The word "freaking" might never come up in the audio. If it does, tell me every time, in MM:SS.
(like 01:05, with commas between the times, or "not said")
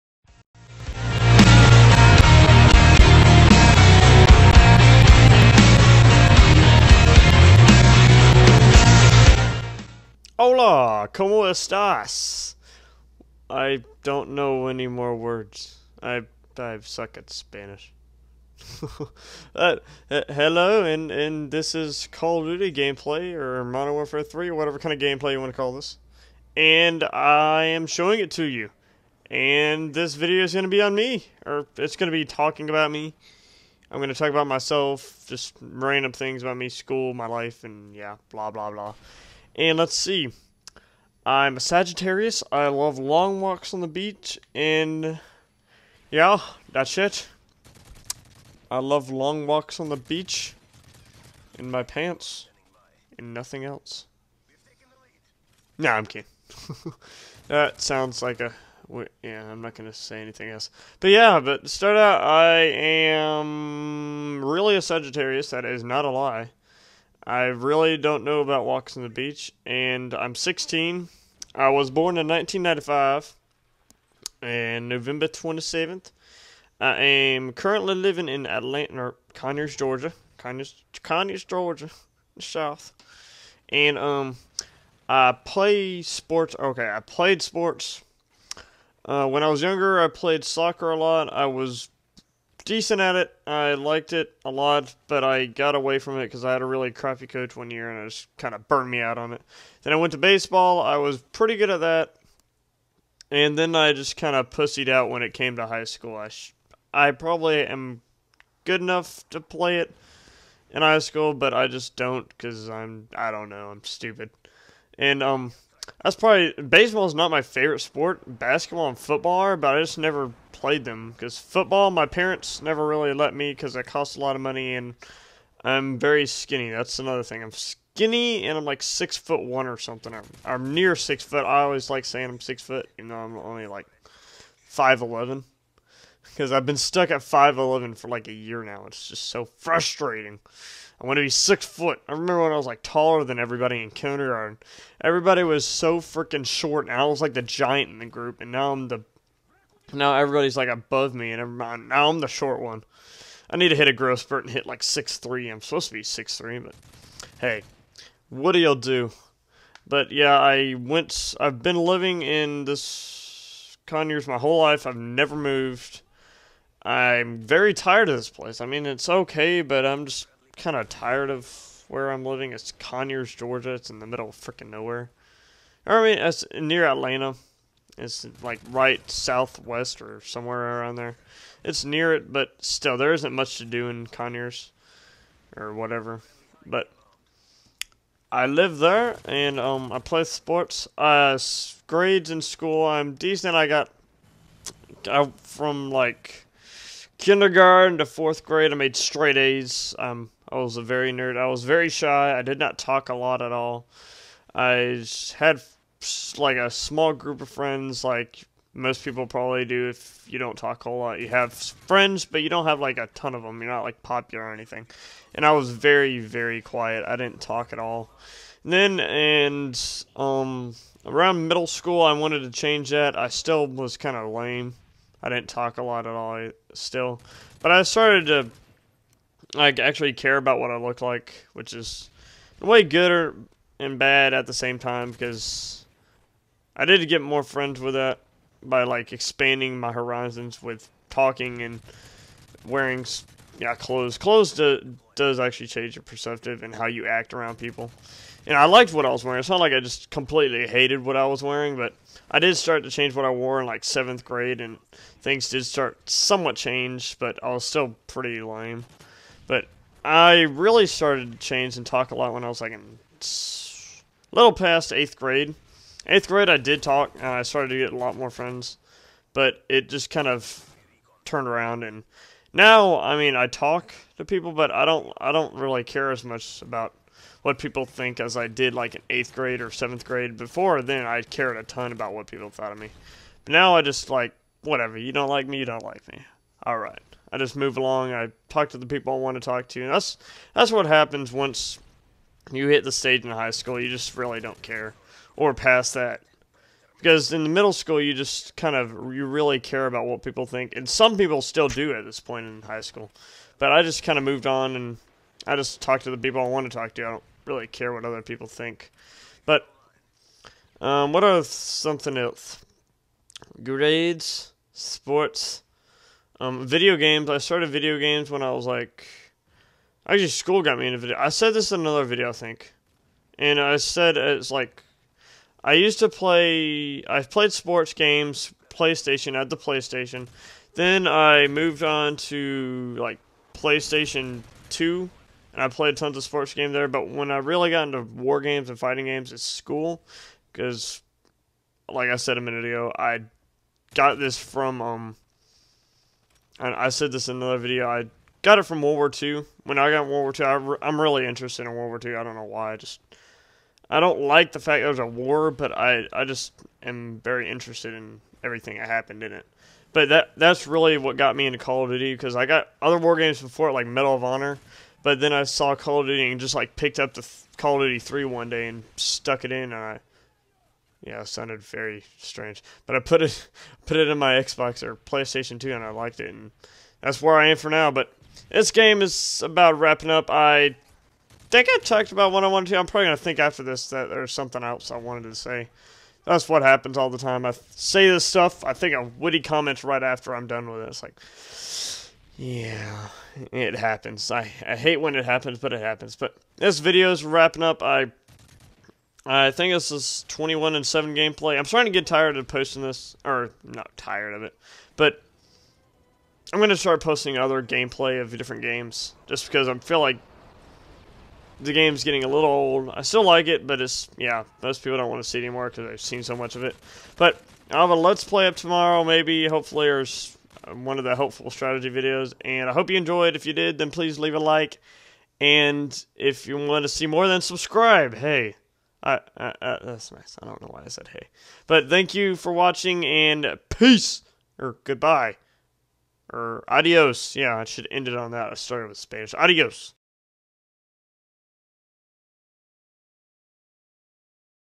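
02:25, 02:54.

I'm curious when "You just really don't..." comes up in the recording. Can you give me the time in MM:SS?
04:53.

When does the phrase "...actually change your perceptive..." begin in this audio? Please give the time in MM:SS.
04:05.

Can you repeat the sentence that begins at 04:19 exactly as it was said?
But I really started to change and talk a lot when I was like in little past eighth grade.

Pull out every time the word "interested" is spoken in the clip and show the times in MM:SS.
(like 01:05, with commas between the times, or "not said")
05:51, 05:57.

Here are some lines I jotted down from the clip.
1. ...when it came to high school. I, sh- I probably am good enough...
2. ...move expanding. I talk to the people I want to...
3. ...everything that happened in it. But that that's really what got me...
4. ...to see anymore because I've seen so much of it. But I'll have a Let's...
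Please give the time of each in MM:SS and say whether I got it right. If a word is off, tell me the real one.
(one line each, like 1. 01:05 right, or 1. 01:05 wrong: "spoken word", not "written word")
1. 01:45 right
2. 04:47 wrong: "along", not "expanding"
3. 05:58 right
4. 06:55 right.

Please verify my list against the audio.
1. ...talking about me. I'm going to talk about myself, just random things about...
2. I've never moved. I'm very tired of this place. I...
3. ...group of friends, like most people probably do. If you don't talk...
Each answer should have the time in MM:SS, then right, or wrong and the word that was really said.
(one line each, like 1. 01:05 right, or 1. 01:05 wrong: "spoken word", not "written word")
1. 00:32 right
2. 02:44 right
3. 03:27 right.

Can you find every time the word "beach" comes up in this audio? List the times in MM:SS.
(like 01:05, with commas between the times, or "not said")
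00:43, 00:49, 01:09.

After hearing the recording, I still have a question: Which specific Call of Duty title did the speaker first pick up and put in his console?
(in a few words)
Call of Duty 3.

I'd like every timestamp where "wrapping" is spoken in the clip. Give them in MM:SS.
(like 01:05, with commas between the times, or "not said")
06:19, 06:37.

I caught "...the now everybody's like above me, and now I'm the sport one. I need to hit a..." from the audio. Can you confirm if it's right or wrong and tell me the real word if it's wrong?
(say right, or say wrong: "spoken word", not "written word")
wrong: "short", not "sport".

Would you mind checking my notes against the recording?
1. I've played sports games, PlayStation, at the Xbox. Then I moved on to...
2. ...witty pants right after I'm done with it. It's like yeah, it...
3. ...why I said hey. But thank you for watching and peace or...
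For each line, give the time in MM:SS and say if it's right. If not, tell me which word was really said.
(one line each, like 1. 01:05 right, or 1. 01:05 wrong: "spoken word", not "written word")
1. 05:27 wrong: "PlayStation", not "Xbox"
2. 06:29 wrong: "comments", not "pants"
3. 07:10 right.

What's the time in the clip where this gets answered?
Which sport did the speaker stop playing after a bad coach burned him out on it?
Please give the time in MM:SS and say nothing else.
01:30.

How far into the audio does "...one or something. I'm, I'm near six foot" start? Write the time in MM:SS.
02:09.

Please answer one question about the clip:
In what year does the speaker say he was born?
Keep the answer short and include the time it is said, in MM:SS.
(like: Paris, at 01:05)
1995, at 01:12.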